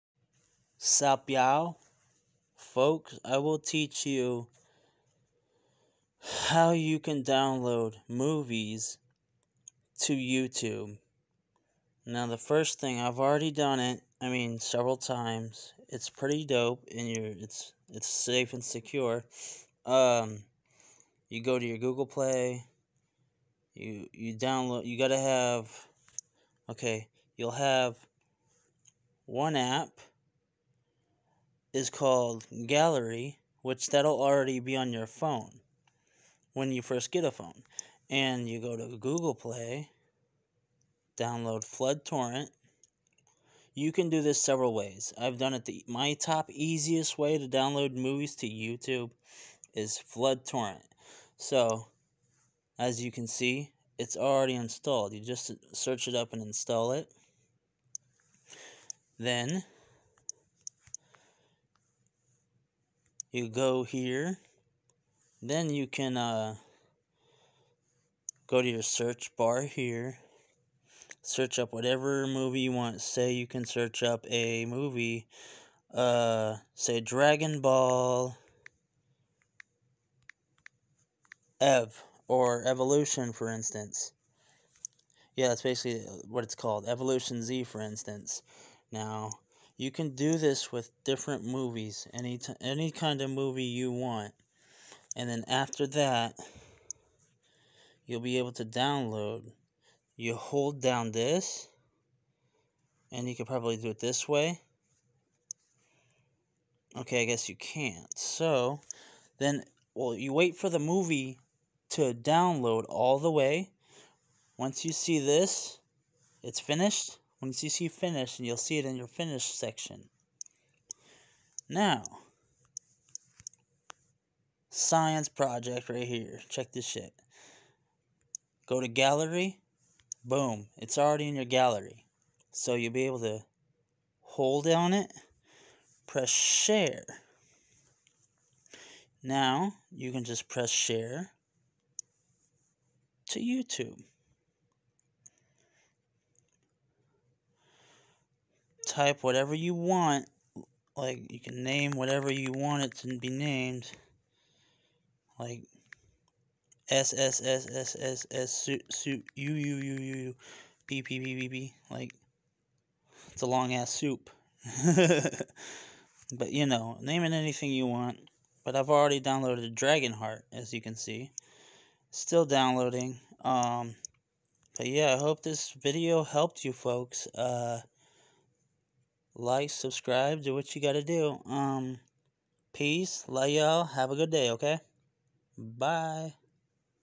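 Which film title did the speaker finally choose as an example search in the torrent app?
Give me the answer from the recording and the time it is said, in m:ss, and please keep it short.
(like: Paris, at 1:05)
Evolution Z, at 1:26.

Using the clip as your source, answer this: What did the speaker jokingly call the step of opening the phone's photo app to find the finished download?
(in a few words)
science project.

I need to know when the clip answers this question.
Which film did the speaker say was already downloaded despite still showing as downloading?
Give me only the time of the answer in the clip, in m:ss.
2:49.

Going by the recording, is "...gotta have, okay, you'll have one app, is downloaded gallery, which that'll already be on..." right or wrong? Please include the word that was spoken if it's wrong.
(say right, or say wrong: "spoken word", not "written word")
wrong: "called", not "downloaded".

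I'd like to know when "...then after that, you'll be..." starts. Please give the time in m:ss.
1:35.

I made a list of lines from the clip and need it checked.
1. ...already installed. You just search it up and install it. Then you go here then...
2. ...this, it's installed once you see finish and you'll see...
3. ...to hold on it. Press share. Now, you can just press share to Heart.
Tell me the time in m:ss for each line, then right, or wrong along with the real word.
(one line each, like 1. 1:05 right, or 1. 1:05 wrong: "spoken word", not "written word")
1. 0:54 right
2. 1:55 wrong: "finished", not "installed"
3. 2:13 wrong: "YouTube", not "Heart".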